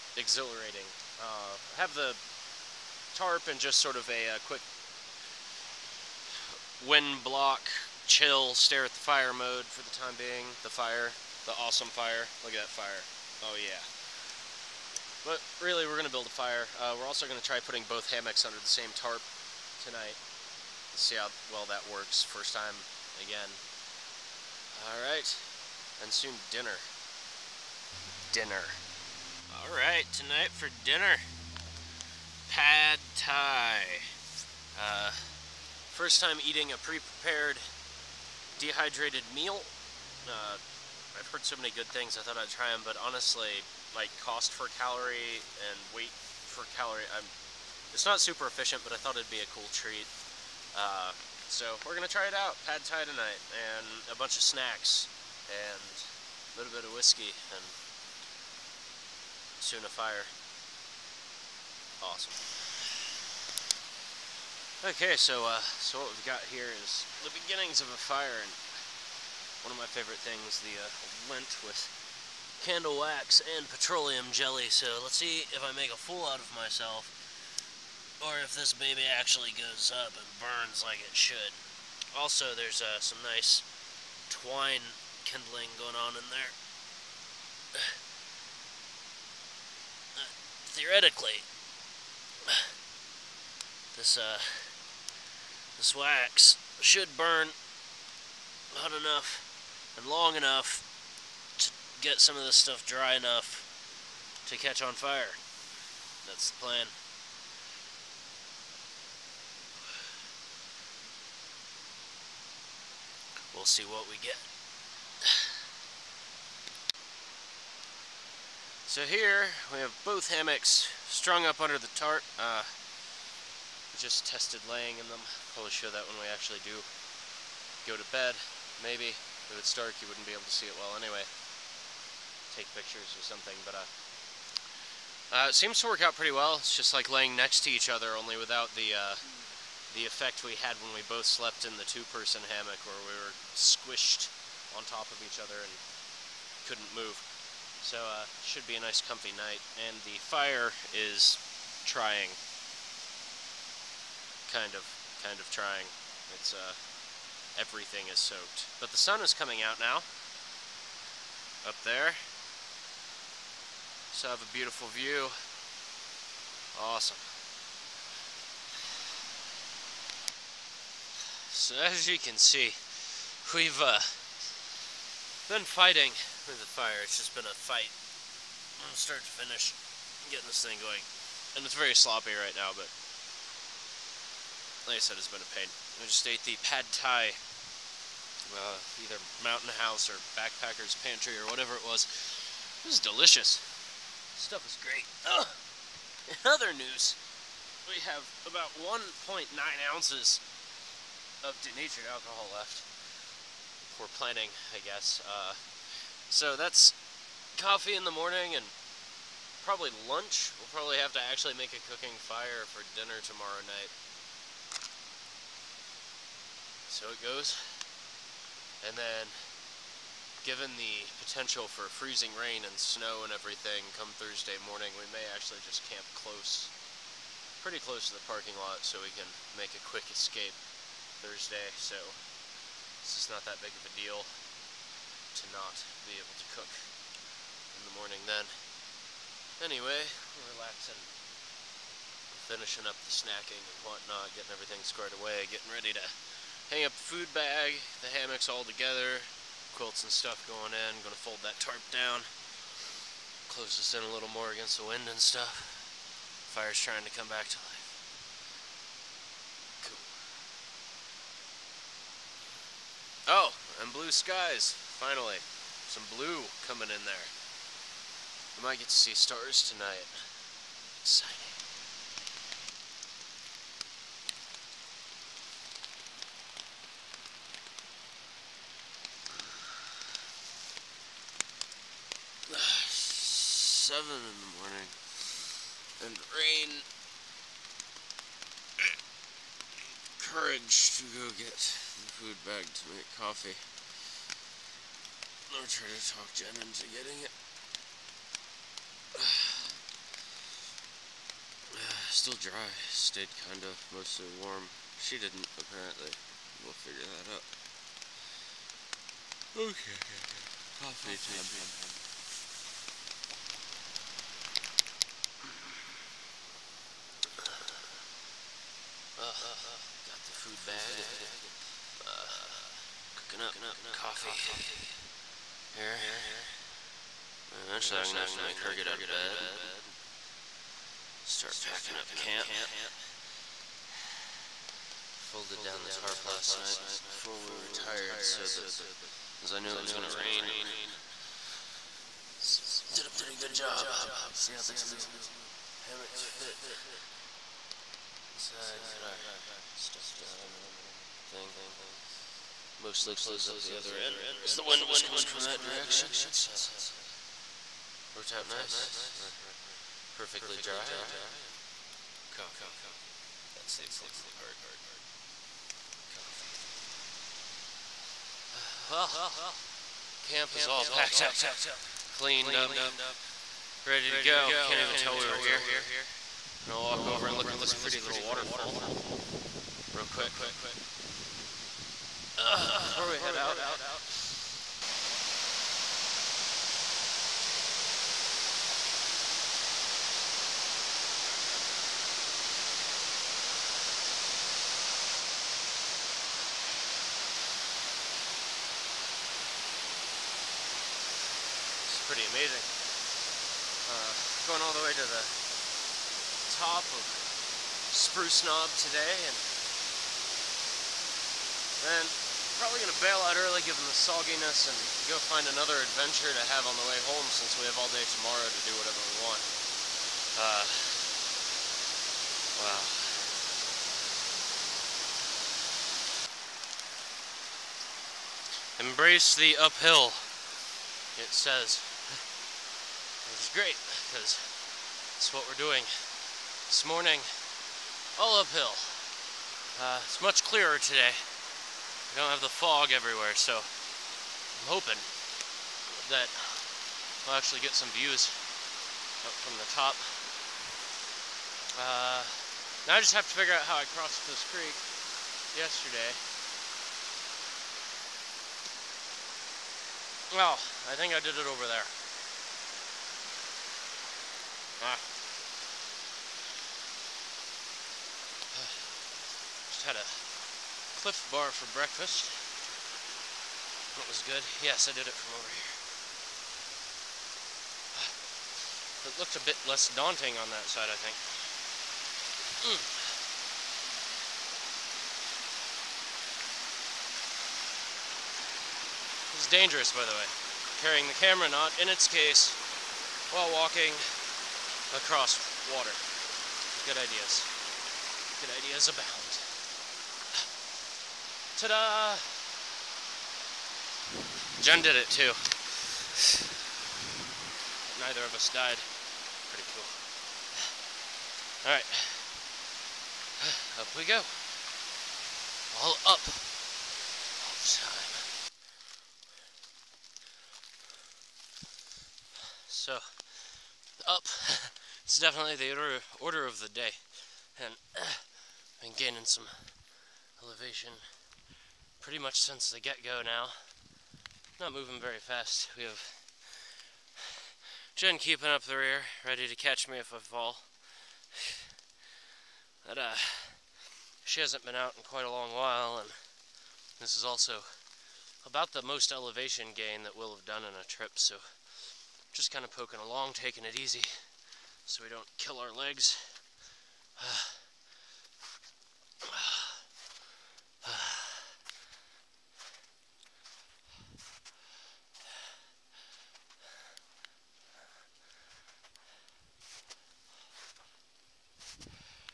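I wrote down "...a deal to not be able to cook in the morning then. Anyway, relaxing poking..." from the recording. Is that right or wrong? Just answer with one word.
wrong.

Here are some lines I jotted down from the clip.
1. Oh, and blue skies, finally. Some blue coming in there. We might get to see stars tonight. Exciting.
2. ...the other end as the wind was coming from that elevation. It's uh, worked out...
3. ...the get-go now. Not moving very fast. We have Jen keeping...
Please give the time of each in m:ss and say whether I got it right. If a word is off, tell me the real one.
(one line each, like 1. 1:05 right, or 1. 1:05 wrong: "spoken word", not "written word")
1. 4:23 right
2. 5:53 wrong: "direction", not "elevation"
3. 8:52 right.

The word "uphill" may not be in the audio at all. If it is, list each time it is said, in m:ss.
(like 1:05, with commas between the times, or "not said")
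7:09, 7:18.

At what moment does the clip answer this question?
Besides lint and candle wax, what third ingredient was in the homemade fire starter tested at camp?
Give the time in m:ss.
1:13.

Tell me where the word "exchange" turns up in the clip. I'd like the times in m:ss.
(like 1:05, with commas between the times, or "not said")
not said.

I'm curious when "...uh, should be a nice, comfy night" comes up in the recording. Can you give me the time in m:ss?
2:28.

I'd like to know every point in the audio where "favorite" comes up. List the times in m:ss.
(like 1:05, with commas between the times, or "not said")
1:09.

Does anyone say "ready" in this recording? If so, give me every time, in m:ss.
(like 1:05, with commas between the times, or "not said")
4:05, 6:13, 8:59.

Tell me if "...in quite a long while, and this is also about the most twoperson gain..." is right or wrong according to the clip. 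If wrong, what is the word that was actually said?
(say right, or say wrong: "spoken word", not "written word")
wrong: "elevation", not "twoperson".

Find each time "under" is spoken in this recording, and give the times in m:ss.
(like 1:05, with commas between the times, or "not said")
0:18, 2:01.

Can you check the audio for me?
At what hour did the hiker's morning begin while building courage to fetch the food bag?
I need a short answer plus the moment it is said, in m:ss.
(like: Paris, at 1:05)
7, at 4:43.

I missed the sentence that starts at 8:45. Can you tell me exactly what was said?
It's definitely the order, order of the day.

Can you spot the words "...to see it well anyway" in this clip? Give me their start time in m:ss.
2:10.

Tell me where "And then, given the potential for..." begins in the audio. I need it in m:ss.
3:38.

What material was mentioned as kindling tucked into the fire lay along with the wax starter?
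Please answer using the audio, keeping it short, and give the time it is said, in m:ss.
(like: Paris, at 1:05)
twine, at 1:24.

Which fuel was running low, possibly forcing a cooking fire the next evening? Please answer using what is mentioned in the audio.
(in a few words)
denatured alcohol.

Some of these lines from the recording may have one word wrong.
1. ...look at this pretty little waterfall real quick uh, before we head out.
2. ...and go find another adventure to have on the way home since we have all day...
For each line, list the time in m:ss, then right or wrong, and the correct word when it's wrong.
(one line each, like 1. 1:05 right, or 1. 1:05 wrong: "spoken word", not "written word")
1. 6:17 right
2. 6:54 right.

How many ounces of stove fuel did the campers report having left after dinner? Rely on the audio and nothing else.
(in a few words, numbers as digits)
1.9.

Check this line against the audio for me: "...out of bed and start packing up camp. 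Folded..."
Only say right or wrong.
right.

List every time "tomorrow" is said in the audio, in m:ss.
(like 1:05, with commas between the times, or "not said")
3:33, 6:58.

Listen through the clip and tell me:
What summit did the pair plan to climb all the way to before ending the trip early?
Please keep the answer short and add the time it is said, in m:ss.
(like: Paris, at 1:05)
Spruce Knob, at 6:47.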